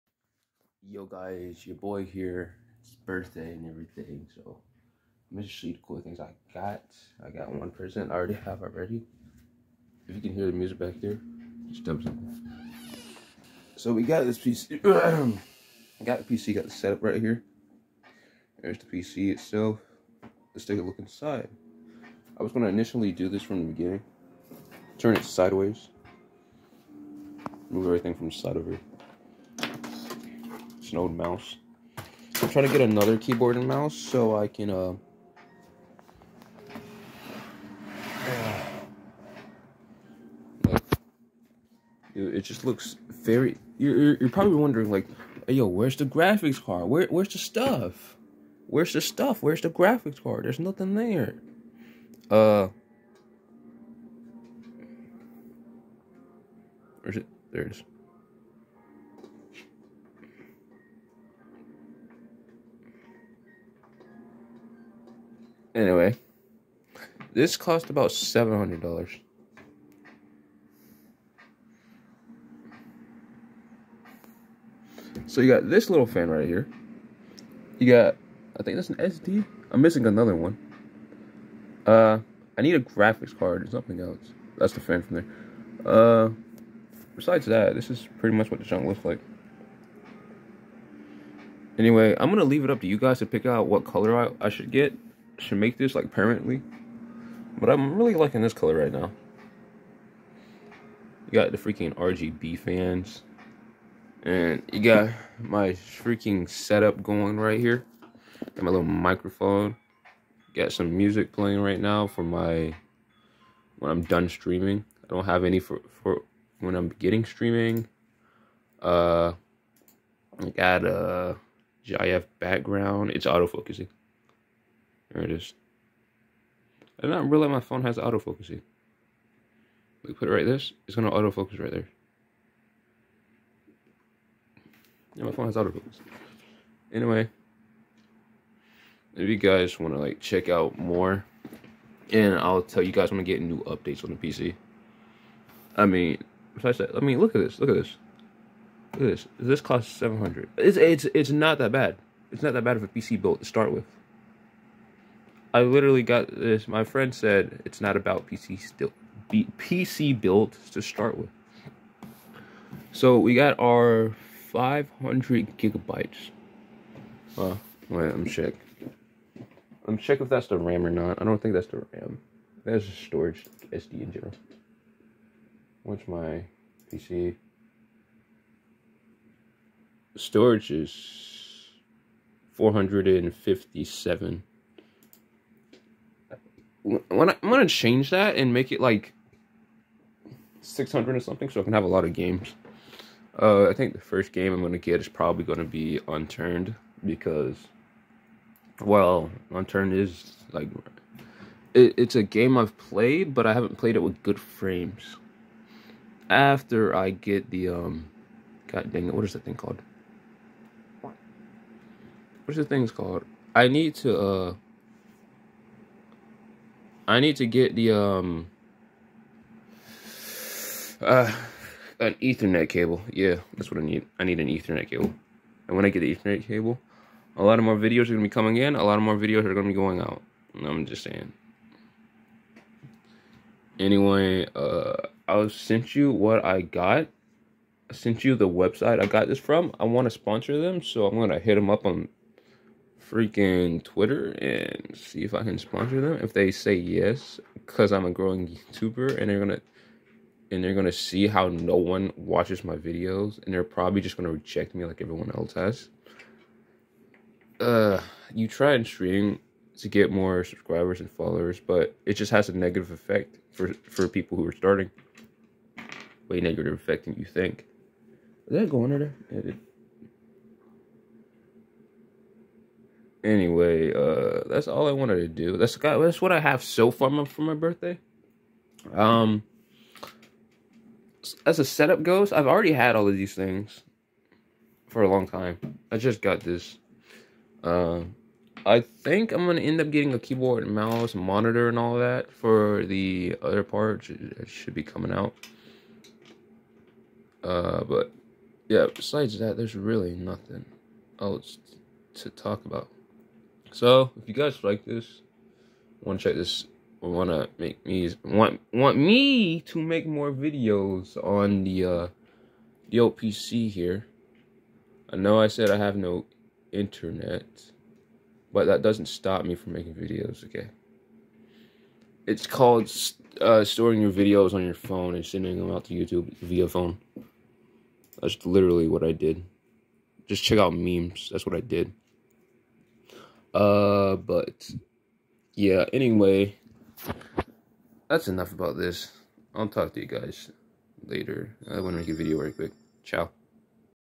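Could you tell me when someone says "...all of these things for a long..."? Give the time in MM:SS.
04:42.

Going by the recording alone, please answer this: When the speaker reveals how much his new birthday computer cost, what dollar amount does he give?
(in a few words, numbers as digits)
$700.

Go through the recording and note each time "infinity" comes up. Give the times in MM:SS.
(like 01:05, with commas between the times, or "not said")
not said.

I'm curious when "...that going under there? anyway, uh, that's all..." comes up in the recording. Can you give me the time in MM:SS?
04:28.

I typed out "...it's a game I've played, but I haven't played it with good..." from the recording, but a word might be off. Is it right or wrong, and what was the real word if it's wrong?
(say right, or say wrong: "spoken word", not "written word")
right.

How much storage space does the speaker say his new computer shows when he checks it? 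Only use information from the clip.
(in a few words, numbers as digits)
457.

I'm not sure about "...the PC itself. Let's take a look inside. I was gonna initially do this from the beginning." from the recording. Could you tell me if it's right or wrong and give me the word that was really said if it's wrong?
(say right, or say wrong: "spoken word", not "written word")
right.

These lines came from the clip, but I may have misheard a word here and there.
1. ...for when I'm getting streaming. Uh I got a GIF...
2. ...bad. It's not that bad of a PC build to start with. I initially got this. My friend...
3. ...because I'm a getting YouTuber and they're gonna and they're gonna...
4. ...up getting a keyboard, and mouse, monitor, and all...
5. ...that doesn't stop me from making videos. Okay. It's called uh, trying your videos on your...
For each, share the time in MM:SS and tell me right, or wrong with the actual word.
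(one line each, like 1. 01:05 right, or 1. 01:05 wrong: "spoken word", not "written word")
1. 01:56 right
2. 02:31 wrong: "literally", not "initially"
3. 04:07 wrong: "growing", not "getting"
4. 04:49 right
5. 05:18 wrong: "storing", not "trying".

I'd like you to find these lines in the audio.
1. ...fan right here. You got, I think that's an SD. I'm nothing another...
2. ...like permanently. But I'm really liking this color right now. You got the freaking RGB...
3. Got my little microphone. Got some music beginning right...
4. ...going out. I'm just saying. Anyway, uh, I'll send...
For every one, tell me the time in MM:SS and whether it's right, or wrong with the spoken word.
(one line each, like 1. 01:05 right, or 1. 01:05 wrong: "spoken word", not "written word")
1. 01:16 wrong: "missing", not "nothing"
2. 01:35 right
3. 01:48 wrong: "playing", not "beginning"
4. 03:49 right.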